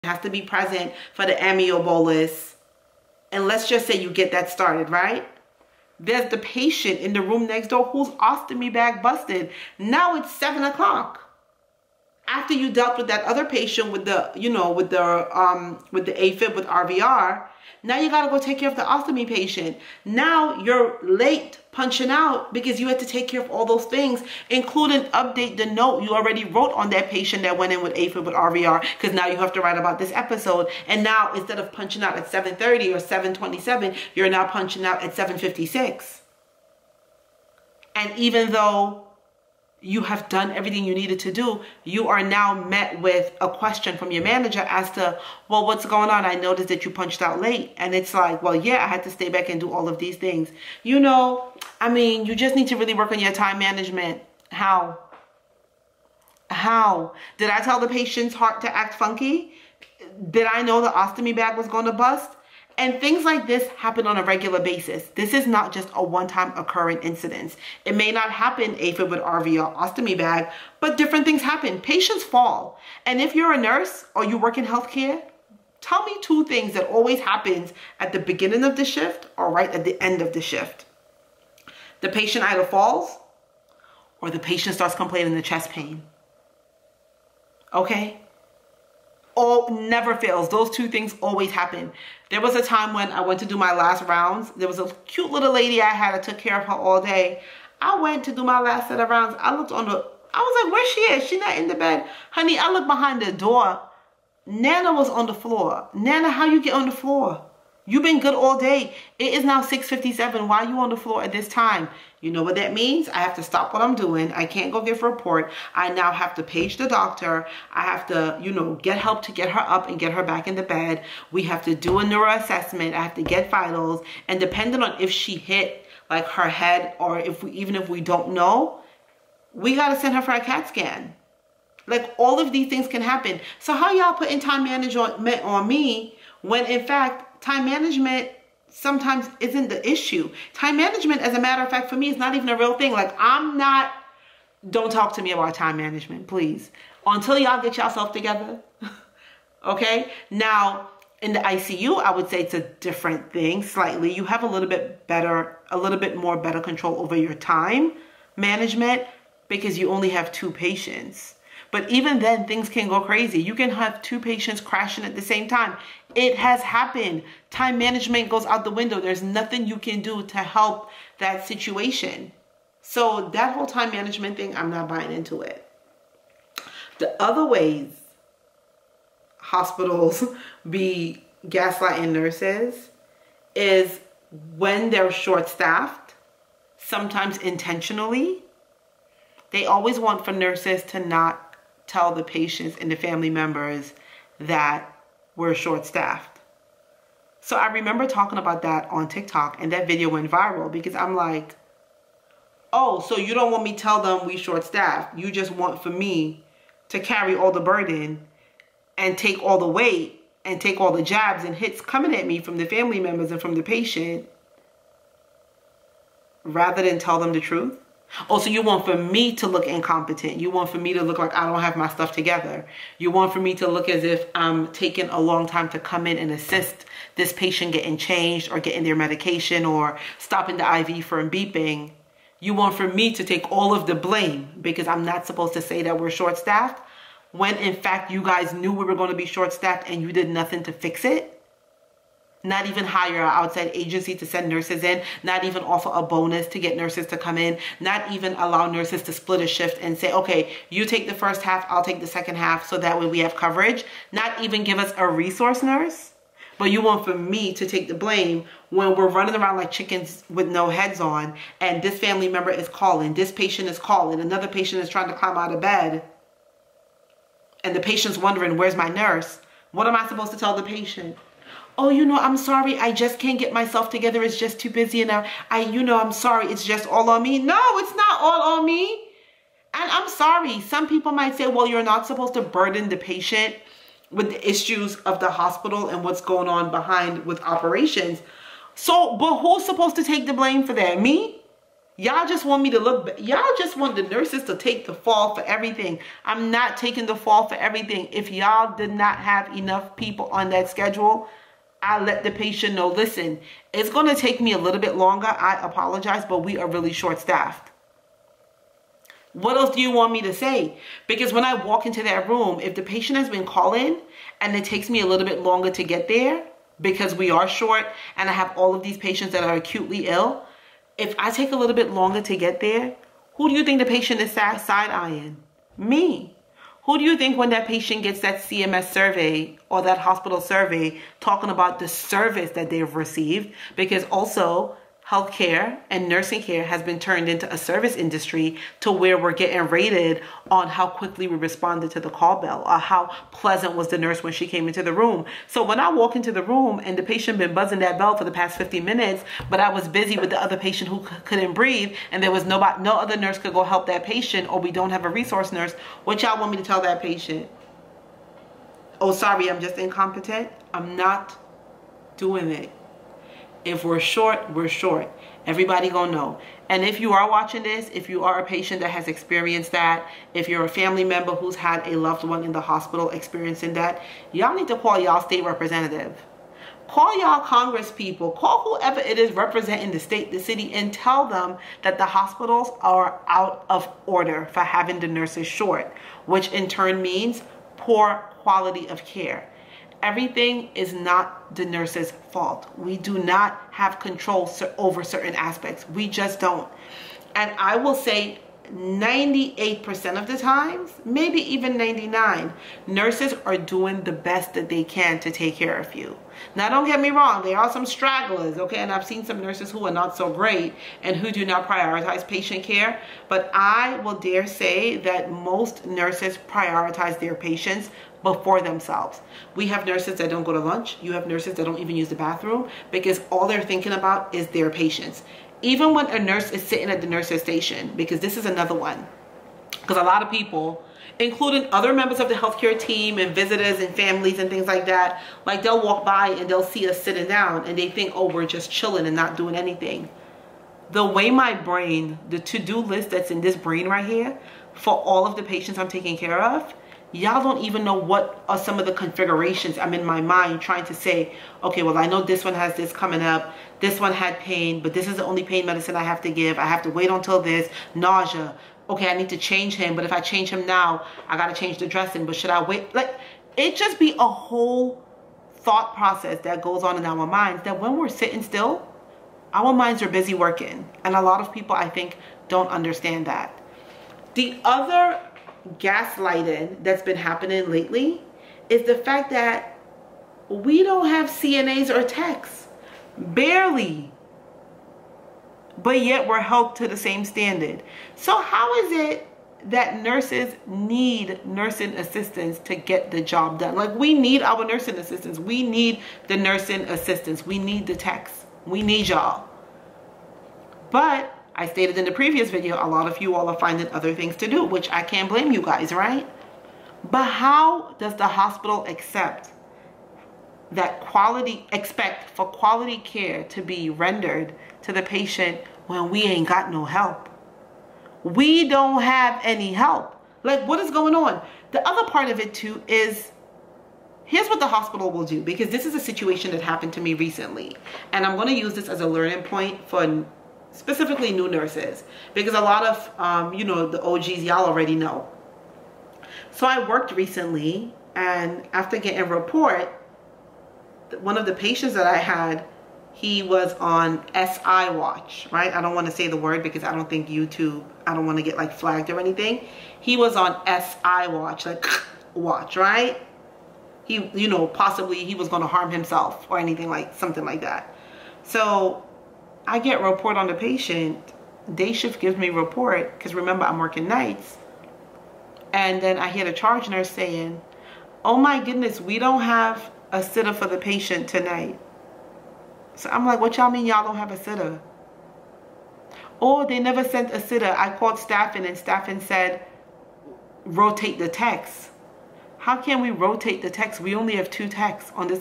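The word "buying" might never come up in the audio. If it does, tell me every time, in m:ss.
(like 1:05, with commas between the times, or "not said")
2:54.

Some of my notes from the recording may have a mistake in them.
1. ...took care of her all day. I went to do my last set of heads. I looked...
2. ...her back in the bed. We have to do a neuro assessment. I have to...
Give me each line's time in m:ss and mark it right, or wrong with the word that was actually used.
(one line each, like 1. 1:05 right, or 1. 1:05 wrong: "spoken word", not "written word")
1. 1:36 wrong: "rounds", not "heads"
2. 2:00 right.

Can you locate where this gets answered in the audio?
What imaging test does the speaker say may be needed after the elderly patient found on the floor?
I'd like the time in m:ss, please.
2:10.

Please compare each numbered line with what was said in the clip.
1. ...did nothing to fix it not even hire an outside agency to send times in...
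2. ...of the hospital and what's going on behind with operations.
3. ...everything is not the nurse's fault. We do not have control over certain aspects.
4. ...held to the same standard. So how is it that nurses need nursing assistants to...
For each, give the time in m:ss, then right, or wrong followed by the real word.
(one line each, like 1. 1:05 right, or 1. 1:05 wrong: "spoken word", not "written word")
1. 4:00 wrong: "nurses", not "times"
2. 4:44 right
3. 6:30 right
4. 8:06 right.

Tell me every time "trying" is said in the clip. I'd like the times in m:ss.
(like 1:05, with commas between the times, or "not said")
4:24, 7:30.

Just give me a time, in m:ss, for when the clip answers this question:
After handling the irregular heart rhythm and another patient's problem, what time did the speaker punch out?
0:35.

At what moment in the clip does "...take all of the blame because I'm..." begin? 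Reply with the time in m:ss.
3:53.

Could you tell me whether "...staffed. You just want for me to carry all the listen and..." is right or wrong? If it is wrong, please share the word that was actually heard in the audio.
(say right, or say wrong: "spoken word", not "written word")
wrong: "burden", not "listen".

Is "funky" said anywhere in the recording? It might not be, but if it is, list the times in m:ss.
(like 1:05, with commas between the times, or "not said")
0:58.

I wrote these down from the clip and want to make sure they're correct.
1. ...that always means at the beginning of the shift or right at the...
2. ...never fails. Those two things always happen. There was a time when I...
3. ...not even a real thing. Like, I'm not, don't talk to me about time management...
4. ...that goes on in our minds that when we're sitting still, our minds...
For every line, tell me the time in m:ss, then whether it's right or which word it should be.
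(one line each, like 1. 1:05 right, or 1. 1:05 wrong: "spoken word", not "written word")
1. 1:16 wrong: "happens", not "means"
2. 1:29 right
3. 2:22 right
4. 7:46 right.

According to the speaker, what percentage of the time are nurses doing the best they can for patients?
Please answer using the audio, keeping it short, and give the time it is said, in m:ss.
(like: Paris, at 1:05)
98%, at 6:38.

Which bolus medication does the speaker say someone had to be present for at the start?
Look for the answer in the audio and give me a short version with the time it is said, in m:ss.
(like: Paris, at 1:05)
amio, at 0:01.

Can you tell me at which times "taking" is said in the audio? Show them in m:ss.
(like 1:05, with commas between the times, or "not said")
3:44, 4:56, 7:25.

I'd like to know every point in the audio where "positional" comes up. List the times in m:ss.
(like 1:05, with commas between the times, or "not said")
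not said.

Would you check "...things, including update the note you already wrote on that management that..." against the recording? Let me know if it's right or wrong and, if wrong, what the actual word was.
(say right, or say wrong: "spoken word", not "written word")
wrong: "patient", not "management".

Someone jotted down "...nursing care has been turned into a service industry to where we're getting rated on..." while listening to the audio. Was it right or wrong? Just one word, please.
right.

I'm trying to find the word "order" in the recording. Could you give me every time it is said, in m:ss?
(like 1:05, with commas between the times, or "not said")
6:24.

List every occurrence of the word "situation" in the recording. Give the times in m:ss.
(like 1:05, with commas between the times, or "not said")
2:51, 8:45.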